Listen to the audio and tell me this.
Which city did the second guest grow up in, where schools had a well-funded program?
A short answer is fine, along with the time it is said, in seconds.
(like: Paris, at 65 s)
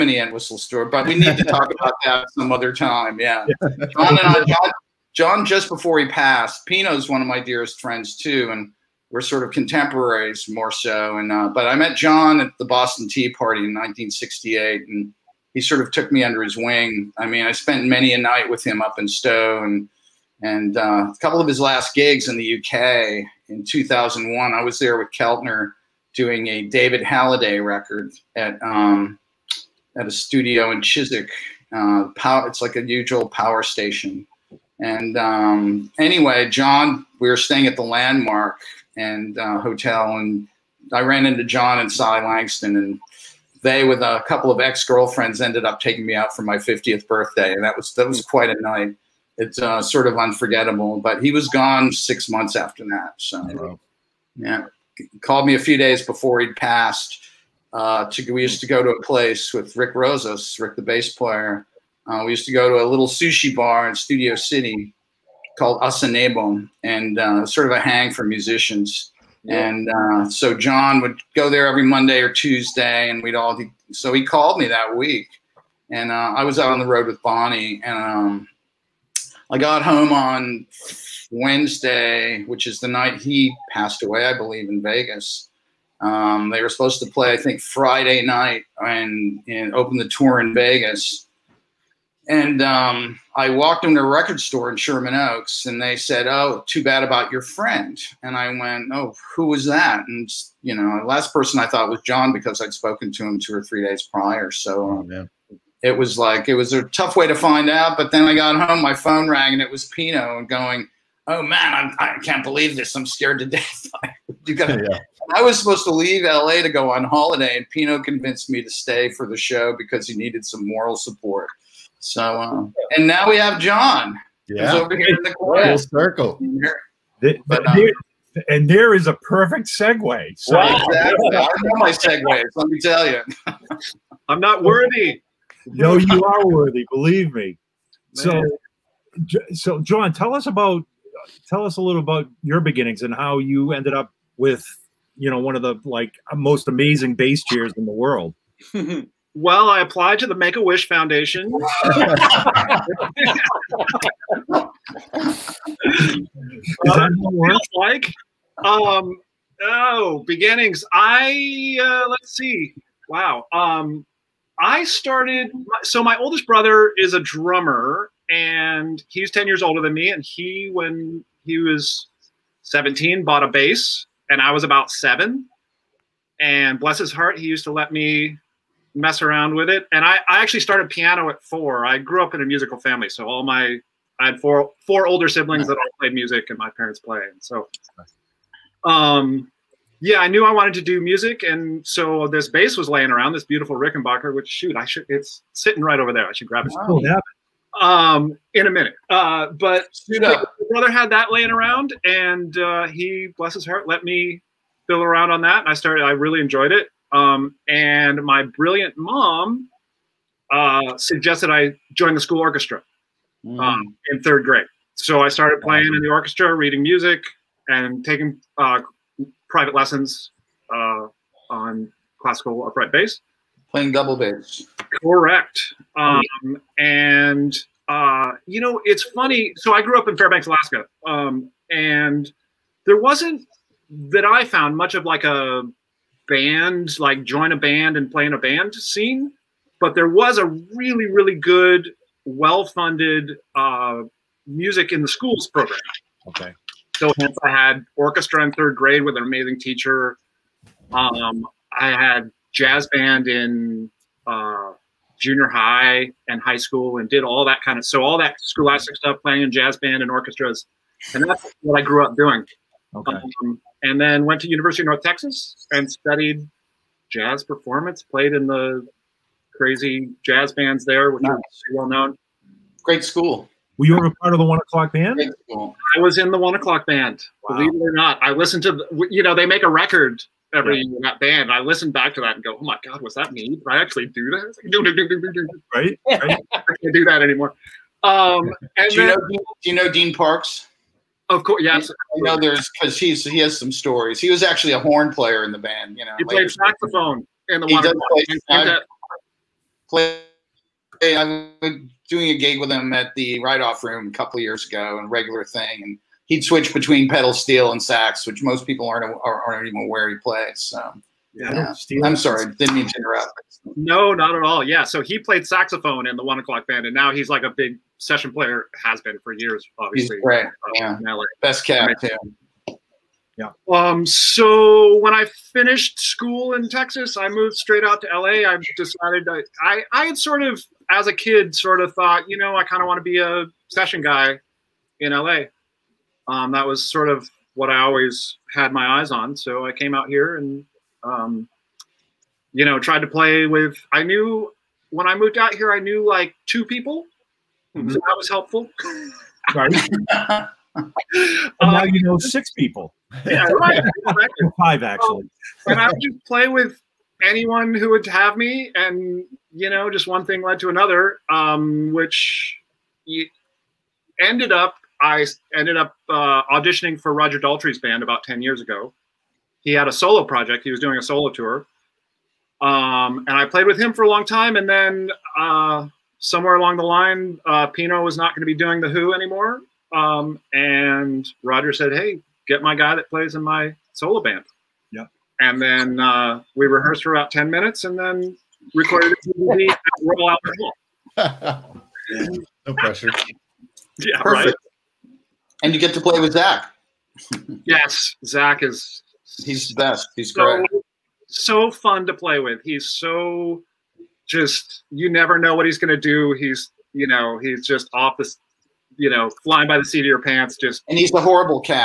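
Fairbanks, Alaska, at 230 s.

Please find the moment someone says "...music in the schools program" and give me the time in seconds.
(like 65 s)
244 s.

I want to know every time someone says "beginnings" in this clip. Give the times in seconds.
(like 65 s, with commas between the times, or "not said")
142 s, 160 s.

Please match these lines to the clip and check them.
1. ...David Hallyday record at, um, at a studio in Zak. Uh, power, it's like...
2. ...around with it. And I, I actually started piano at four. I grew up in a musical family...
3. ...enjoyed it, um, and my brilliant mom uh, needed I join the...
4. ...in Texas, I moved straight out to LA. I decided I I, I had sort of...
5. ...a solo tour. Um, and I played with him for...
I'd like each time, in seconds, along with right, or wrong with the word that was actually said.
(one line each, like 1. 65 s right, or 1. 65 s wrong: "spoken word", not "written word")
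1. 26 s wrong: "Chiswick", not "Zak"
2. 179 s right
3. 206 s wrong: "suggested", not "needed"
4. 326 s right
5. 370 s right.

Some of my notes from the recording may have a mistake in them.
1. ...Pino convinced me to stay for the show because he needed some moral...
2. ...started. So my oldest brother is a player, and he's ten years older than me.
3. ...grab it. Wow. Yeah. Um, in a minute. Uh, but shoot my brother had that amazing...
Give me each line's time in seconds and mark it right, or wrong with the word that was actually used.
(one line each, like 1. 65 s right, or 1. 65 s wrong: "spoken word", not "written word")
1. 117 s right
2. 164 s wrong: "drummer", not "player"
3. 196 s wrong: "laying", not "amazing".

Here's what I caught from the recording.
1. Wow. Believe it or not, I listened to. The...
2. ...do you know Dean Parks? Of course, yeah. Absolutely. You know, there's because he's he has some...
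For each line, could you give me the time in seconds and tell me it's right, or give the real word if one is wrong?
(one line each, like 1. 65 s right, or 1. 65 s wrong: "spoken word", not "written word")
1. 277 s right
2. 289 s right.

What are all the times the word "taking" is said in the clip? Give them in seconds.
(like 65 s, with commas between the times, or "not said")
45 s, 218 s.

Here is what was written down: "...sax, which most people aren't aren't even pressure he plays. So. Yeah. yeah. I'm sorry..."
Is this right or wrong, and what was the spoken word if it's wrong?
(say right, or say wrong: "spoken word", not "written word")
wrong: "aware", not "pressure".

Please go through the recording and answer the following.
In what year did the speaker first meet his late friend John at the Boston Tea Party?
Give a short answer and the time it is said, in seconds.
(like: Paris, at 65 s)
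1968, at 13 s.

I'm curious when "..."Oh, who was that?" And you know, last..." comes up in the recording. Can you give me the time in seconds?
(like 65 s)
98 s.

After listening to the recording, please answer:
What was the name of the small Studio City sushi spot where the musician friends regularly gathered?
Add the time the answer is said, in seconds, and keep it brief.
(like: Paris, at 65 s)
Asanebo, at 65 s.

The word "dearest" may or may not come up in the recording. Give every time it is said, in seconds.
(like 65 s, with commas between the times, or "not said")
7 s.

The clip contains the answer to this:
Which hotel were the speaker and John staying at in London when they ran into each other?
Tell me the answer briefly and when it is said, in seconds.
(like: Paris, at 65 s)
The Landmark, at 37 s.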